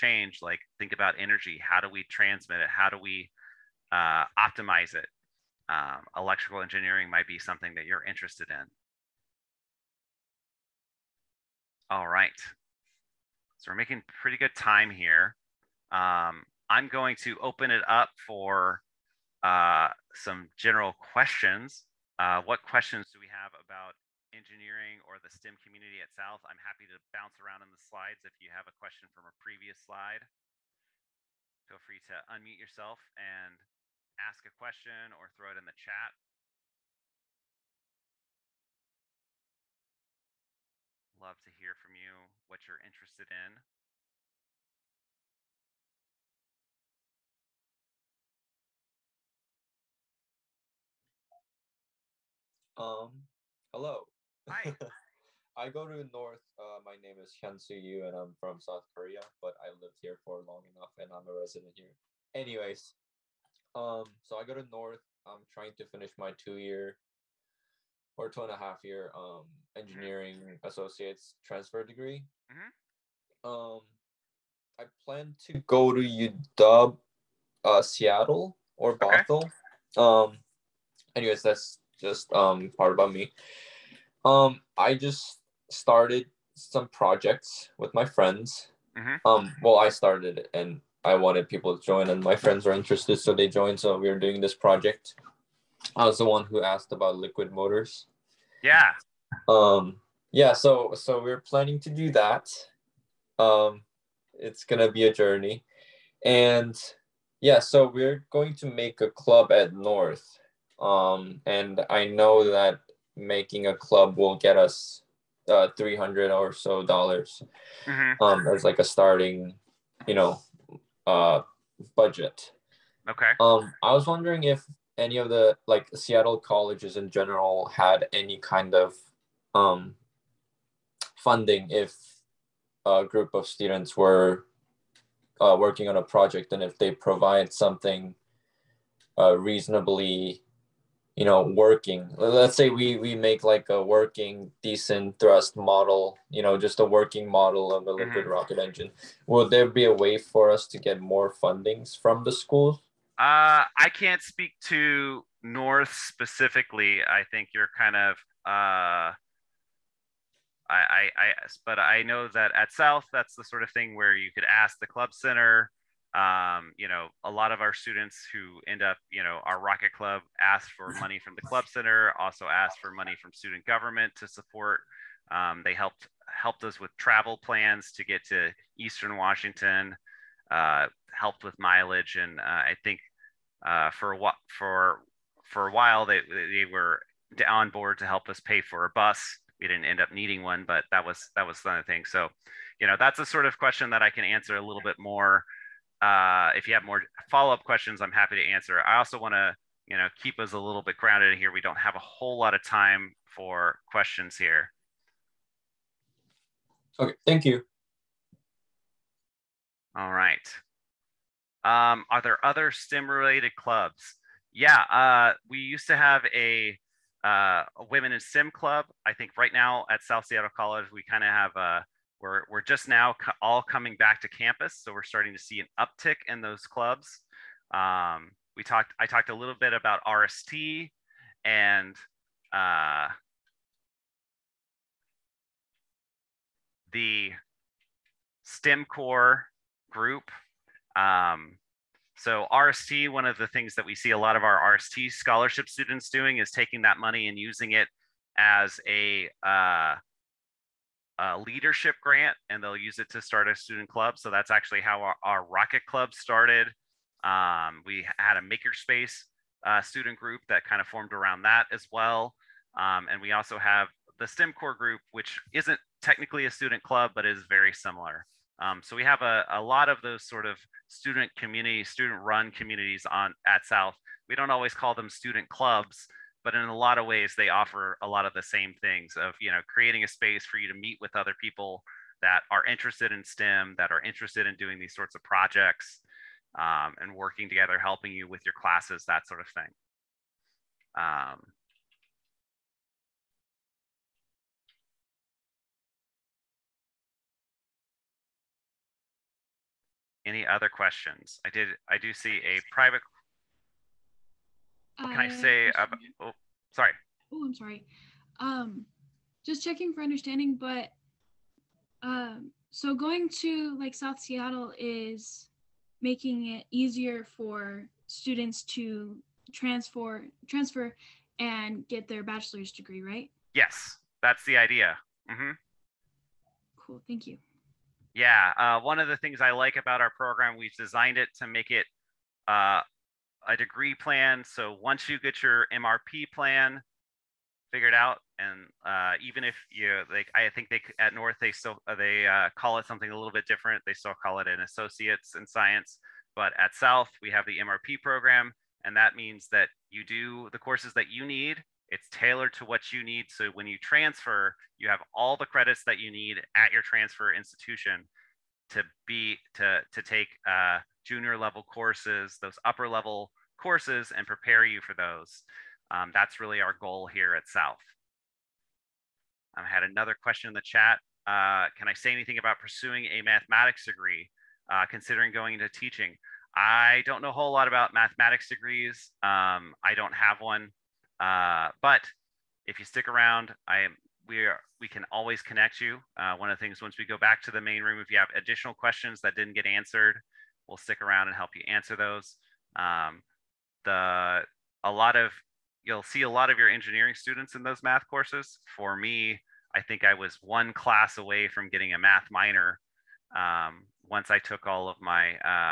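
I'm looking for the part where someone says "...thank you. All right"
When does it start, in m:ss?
3:27.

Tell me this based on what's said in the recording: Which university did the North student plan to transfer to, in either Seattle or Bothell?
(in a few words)
UW.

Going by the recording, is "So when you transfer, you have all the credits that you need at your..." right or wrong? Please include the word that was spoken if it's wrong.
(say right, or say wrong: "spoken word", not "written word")
right.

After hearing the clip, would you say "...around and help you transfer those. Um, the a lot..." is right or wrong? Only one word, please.
wrong.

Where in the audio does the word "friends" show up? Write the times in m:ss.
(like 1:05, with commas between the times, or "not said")
1:28, 1:32.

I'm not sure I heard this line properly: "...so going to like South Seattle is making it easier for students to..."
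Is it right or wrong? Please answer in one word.
right.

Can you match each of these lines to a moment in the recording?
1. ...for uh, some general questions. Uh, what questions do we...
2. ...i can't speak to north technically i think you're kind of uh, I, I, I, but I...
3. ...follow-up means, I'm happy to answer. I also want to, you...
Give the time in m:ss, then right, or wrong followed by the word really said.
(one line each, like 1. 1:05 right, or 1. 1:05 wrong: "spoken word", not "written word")
1. 0:18 right
2. 2:33 wrong: "specifically", not "technically"
3. 3:17 wrong: "questions", not "means".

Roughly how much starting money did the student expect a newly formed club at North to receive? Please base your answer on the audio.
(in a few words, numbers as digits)
300 dollars.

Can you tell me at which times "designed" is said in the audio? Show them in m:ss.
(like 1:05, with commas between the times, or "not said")
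5:30.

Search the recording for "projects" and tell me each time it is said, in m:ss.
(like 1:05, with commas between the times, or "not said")
1:26, 1:34, 2:16, 4:45.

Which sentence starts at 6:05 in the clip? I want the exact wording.
Um, that's really our goal here at South.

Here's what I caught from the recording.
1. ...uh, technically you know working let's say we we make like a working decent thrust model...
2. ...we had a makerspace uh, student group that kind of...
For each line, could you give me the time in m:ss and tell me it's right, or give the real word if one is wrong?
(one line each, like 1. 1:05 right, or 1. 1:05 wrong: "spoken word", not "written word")
1. 2:19 wrong: "reasonably", not "technically"
2. 4:17 right.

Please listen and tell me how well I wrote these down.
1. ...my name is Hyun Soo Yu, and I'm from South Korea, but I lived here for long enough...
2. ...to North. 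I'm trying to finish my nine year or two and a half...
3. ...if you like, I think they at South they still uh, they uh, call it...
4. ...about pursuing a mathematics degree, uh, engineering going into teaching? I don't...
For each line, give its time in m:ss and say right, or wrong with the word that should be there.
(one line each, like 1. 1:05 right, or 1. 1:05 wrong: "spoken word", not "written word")
1. 0:56 right
2. 1:04 wrong: "two", not "nine"
3. 5:39 wrong: "North", not "South"
4. 6:12 wrong: "considering", not "engineering".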